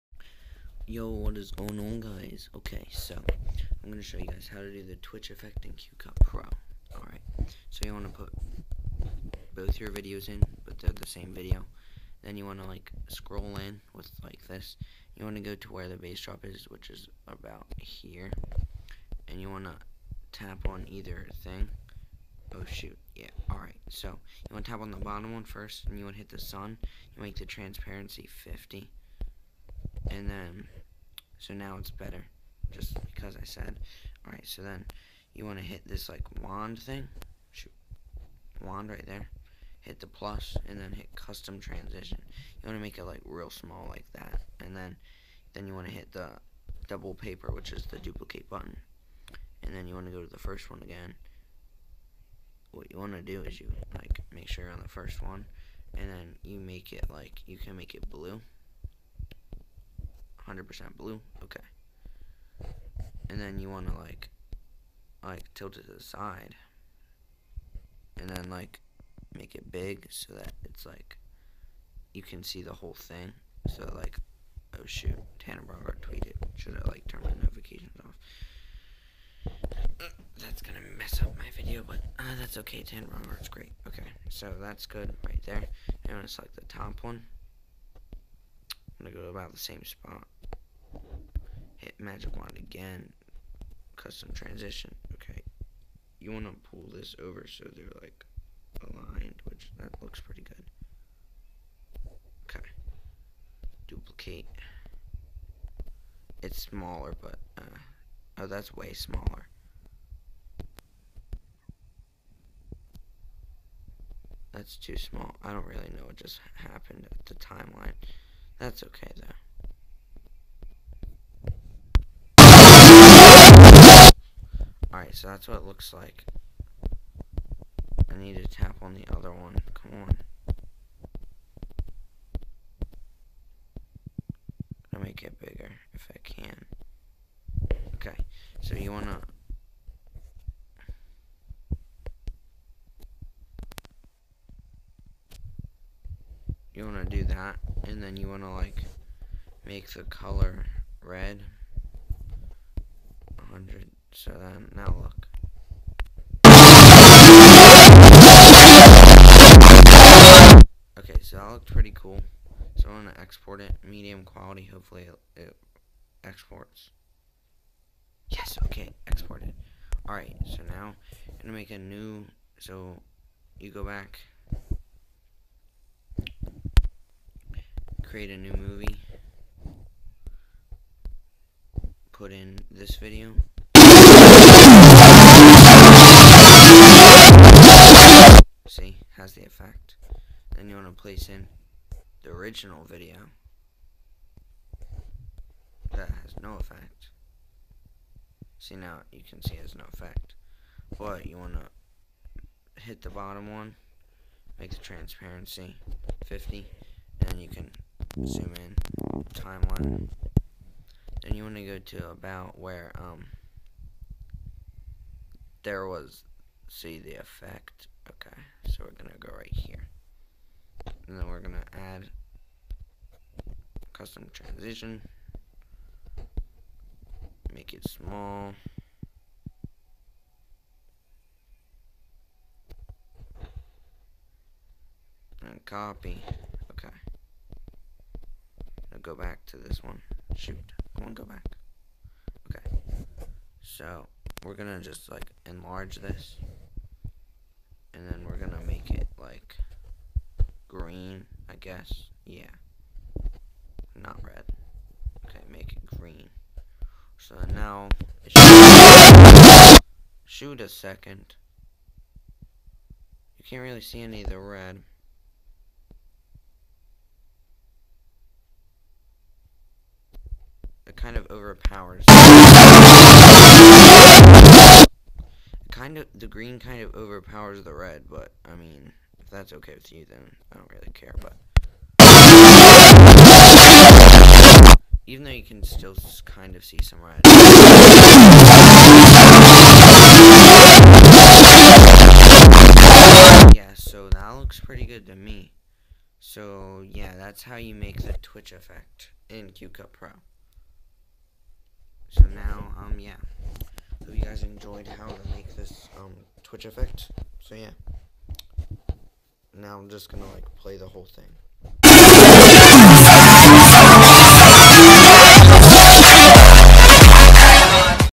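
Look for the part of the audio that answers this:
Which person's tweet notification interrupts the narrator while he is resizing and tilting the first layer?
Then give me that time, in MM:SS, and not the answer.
01:15.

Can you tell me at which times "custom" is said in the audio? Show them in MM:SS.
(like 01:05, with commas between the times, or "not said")
00:41, 01:33, 03:44.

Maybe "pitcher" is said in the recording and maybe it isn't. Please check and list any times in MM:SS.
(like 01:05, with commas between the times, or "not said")
not said.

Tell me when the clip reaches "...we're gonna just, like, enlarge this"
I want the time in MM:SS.
04:04.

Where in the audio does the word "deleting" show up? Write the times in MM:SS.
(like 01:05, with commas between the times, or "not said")
not said.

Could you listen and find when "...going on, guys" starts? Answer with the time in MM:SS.
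00:01.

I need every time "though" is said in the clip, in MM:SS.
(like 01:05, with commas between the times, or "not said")
01:59, 04:45.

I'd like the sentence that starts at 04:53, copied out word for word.
Yeah, so that looks pretty good to me.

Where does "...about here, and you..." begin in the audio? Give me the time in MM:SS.
00:17.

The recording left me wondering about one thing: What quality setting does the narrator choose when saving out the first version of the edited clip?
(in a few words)
Medium quality.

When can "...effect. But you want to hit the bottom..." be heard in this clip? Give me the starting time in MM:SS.
03:19.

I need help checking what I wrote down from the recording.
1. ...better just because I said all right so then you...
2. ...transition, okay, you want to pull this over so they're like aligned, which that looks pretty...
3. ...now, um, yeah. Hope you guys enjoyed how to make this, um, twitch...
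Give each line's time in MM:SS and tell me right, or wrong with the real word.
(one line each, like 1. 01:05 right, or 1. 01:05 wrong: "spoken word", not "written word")
1. 00:31 right
2. 01:34 right
3. 05:02 right.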